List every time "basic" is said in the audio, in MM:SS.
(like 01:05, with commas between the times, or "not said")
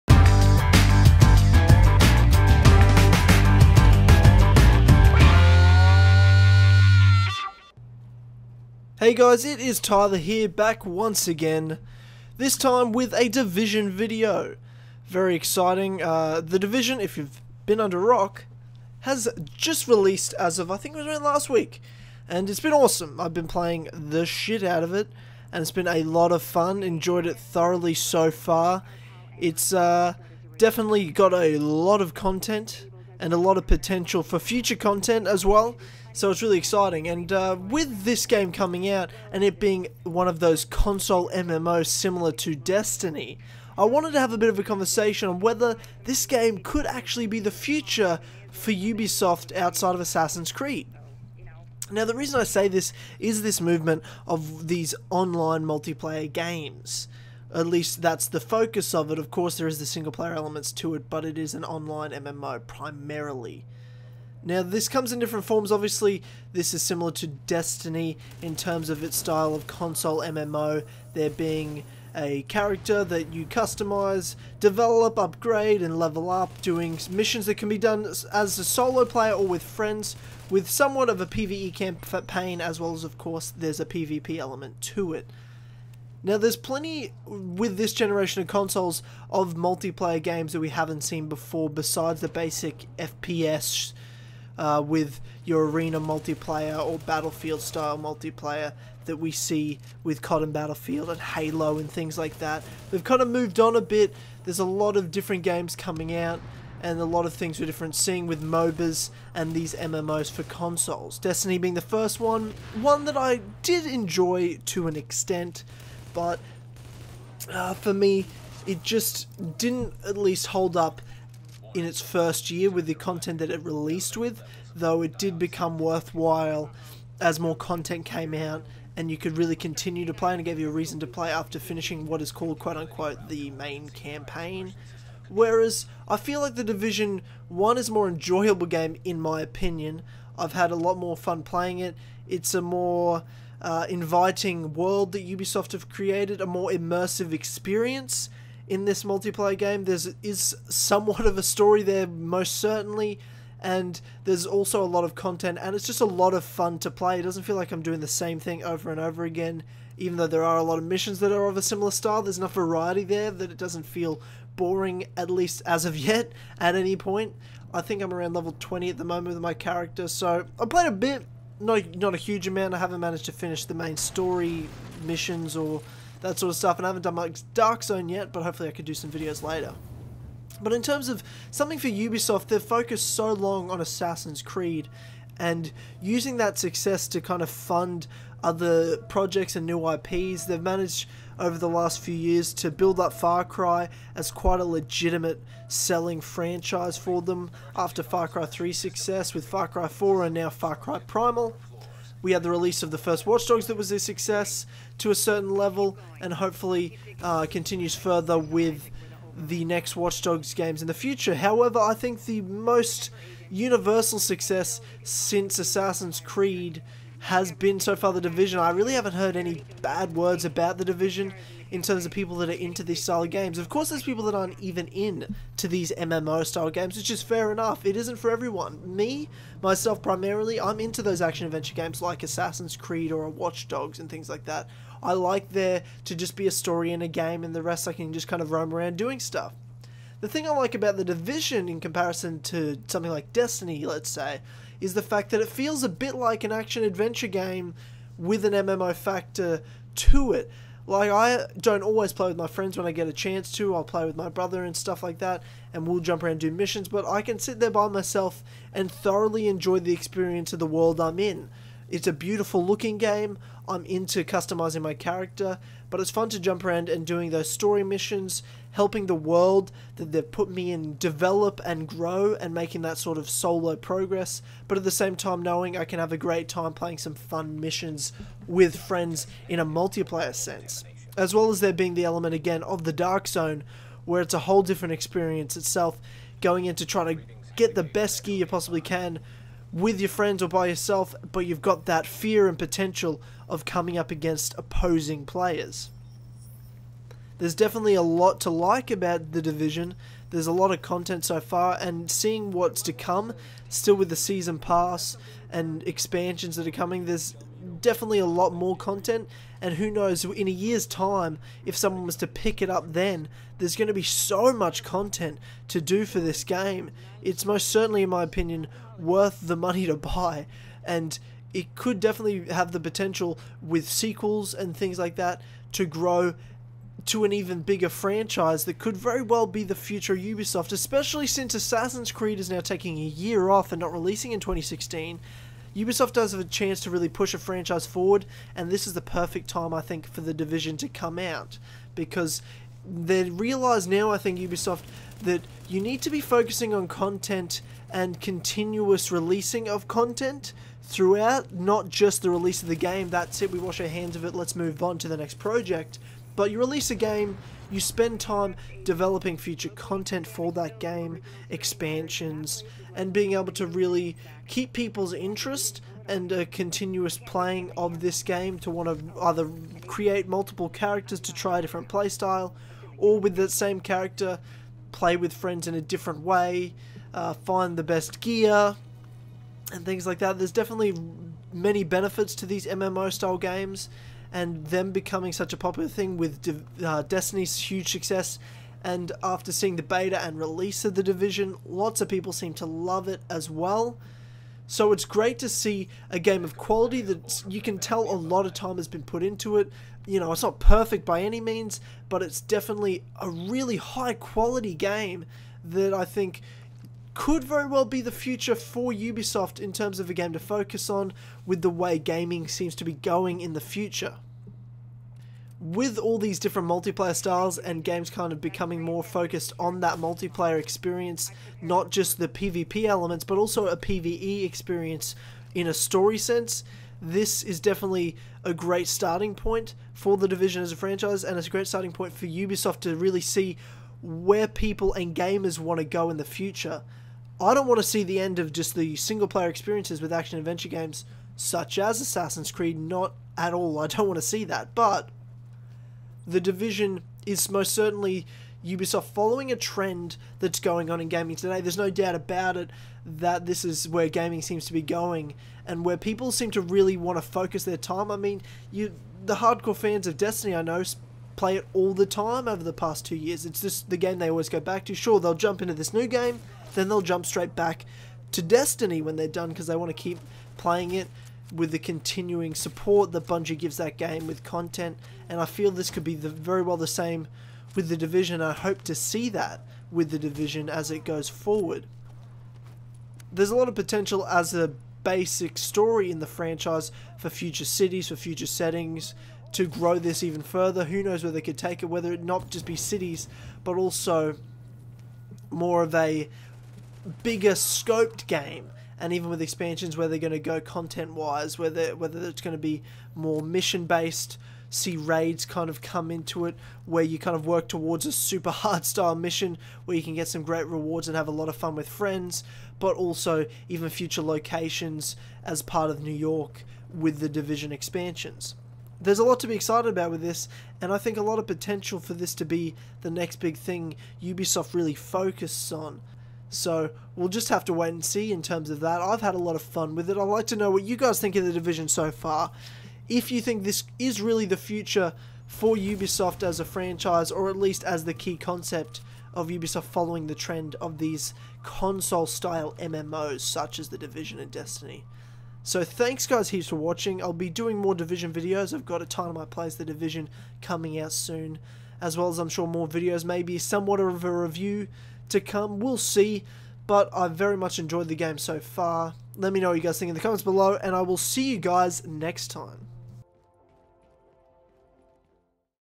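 01:32, 08:05.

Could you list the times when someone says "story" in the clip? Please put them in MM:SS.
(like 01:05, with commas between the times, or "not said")
02:31, 02:53, 03:56, 04:27, 07:05, 08:05.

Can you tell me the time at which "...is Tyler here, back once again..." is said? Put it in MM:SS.
00:09.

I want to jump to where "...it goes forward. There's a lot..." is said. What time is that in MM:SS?
08:00.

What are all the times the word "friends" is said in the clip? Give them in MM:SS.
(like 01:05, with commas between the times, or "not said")
01:19, 04:12, 04:38, 04:50, 06:15, 08:31.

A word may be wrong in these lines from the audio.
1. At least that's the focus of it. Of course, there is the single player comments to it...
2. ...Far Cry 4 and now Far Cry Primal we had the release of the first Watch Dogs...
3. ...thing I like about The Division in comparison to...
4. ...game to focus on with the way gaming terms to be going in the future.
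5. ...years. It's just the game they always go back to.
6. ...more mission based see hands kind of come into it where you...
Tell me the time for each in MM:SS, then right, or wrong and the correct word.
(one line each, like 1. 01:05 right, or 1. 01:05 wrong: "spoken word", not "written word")
1. 00:57 wrong: "elements", not "comments"
2. 03:19 right
3. 04:00 right
4. 06:50 wrong: "seems", not "terms"
5. 07:43 right
6. 08:23 wrong: "raids", not "hands".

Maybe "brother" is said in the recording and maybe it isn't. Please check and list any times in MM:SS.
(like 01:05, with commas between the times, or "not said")
04:14.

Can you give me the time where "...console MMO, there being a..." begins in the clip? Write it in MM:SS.
01:09.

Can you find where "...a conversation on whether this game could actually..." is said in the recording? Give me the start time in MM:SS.
00:44.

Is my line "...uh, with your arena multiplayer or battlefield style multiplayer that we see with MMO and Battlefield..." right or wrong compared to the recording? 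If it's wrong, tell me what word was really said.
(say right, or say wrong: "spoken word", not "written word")
wrong: "CoD", not "MMO".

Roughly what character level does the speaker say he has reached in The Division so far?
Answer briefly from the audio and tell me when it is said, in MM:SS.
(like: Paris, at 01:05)
20, at 02:48.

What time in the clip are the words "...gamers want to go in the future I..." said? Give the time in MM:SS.
07:15.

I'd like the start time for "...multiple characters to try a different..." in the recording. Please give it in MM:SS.
06:10.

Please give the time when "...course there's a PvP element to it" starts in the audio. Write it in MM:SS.
01:23.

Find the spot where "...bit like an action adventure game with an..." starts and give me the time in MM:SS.
04:05.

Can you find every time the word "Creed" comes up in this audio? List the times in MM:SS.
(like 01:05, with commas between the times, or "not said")
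00:50, 03:04, 03:36, 03:52, 05:32, 07:22.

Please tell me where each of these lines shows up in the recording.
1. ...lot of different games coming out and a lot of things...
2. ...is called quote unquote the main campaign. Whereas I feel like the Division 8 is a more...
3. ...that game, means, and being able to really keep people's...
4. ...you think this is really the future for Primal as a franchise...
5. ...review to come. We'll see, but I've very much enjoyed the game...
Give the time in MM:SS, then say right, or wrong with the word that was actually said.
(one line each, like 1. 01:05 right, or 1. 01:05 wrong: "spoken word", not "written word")
1. 01:44 right
2. 02:12 wrong: "1", not "8"
3. 06:00 wrong: "expansions", not "means"
4. 08:53 wrong: "Ubisoft", not "Primal"
5. 09:14 right.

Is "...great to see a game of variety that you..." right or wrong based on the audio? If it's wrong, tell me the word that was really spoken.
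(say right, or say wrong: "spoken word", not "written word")
wrong: "quality", not "variety".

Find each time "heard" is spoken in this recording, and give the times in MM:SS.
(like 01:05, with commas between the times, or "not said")
03:39.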